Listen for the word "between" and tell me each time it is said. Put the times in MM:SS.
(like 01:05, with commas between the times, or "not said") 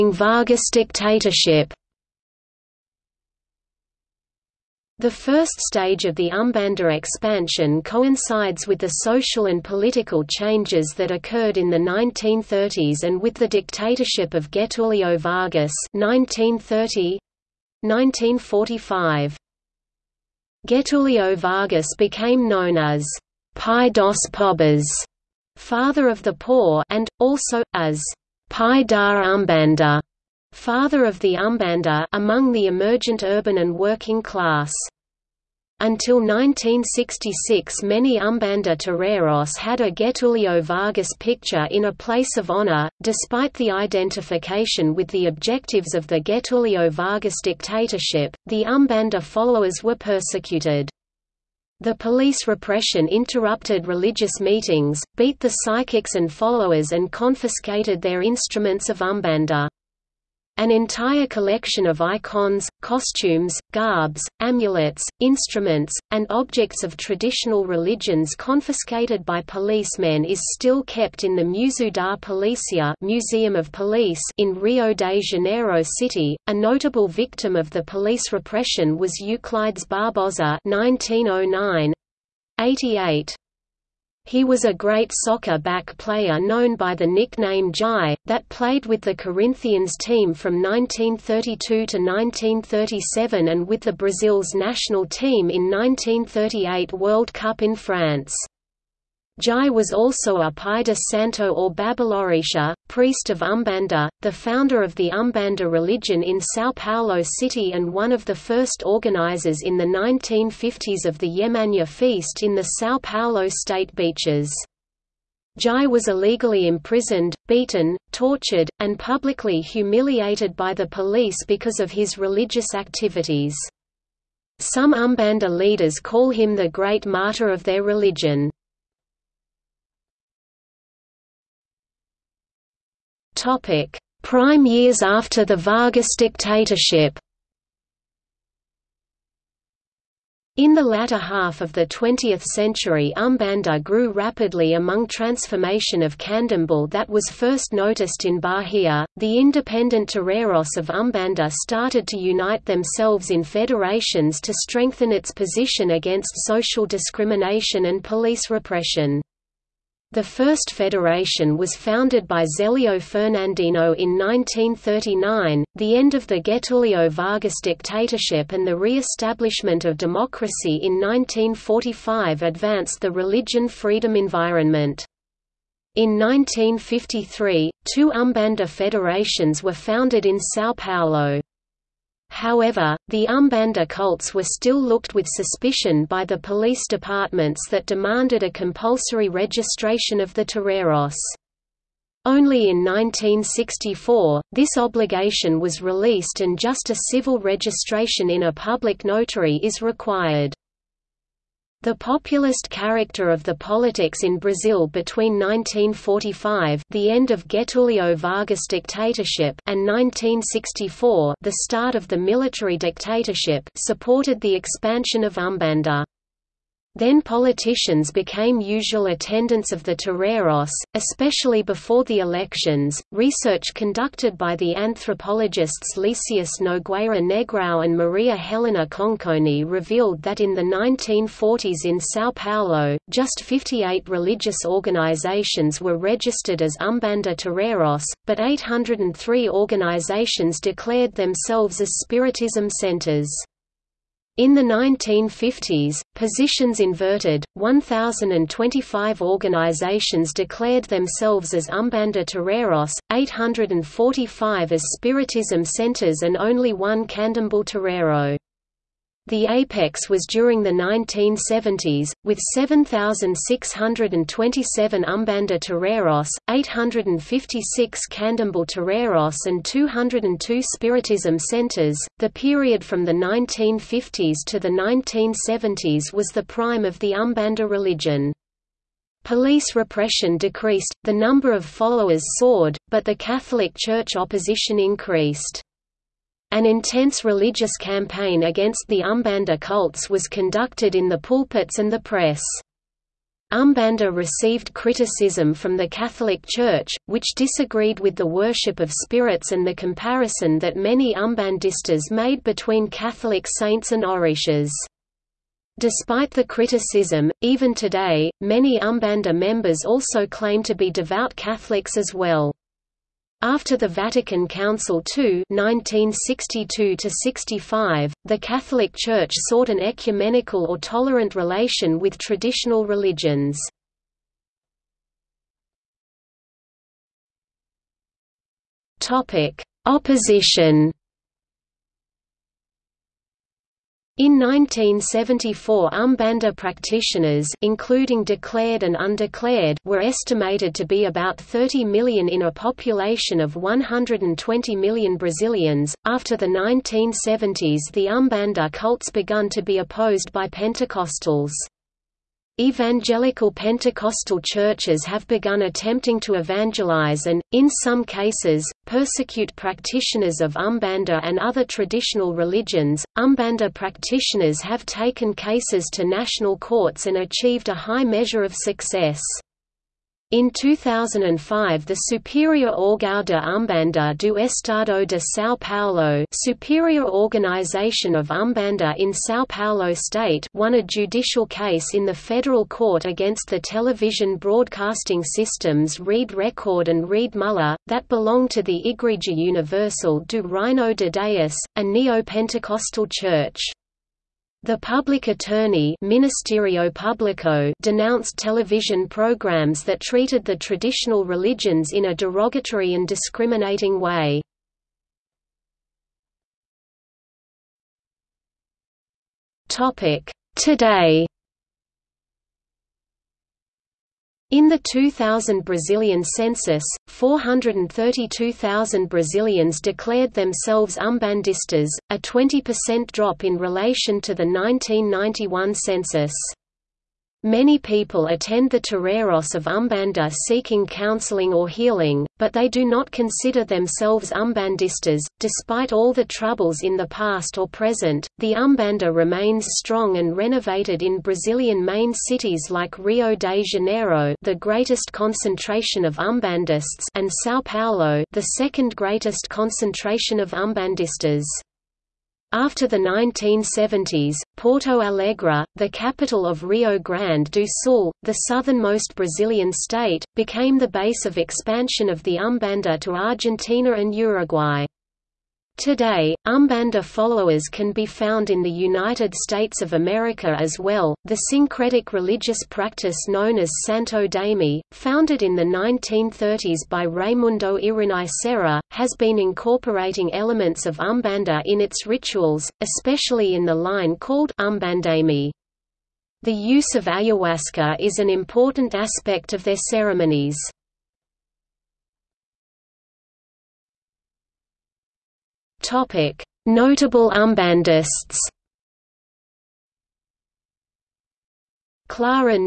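03:24, 05:02.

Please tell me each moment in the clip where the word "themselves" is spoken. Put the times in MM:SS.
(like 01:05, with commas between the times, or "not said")
02:32, 04:01, 04:10, 07:00, 07:13.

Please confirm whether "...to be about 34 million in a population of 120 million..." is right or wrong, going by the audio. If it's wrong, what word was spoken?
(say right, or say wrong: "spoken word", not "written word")
wrong: "30", not "34".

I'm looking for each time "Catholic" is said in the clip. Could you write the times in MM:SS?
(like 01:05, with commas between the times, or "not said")
04:43, 04:55, 05:02, 05:11, 05:18.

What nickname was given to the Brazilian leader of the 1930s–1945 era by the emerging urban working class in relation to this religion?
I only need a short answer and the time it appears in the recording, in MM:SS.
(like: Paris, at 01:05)
Pai da Umbanda, at 00:28.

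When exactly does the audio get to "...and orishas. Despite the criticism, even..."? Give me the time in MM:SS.
05:03.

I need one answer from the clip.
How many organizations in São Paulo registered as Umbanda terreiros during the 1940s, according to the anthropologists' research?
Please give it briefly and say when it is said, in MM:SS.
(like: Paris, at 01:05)
58, at 03:53.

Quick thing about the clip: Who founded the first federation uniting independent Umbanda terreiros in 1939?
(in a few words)
Zelio Fernandino.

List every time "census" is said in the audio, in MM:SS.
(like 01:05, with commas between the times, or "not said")
06:56, 07:05.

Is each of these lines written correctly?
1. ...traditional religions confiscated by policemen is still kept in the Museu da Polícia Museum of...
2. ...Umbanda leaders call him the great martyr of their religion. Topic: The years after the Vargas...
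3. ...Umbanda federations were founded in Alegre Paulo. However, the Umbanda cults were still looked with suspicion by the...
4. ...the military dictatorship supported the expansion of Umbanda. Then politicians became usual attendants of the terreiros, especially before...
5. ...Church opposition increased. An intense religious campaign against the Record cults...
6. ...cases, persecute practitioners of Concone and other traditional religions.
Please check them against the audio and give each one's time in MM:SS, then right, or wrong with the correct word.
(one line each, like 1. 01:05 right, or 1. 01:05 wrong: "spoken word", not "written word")
1. 01:06 right
2. 02:04 wrong: "Prime", not "The"
3. 02:58 wrong: "São", not "Alegre"
4. 03:32 right
5. 04:43 wrong: "Umbanda", not "Record"
6. 05:58 wrong: "Umbanda", not "Concone".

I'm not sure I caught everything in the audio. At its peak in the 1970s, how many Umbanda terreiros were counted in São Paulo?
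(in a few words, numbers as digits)
7,627.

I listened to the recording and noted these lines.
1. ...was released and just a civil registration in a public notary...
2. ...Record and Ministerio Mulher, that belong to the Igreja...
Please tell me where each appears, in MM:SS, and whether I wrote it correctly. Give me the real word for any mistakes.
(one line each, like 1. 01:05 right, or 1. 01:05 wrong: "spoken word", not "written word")
1. 03:15 right
2. 06:26 wrong: "Rede", not "Ministerio".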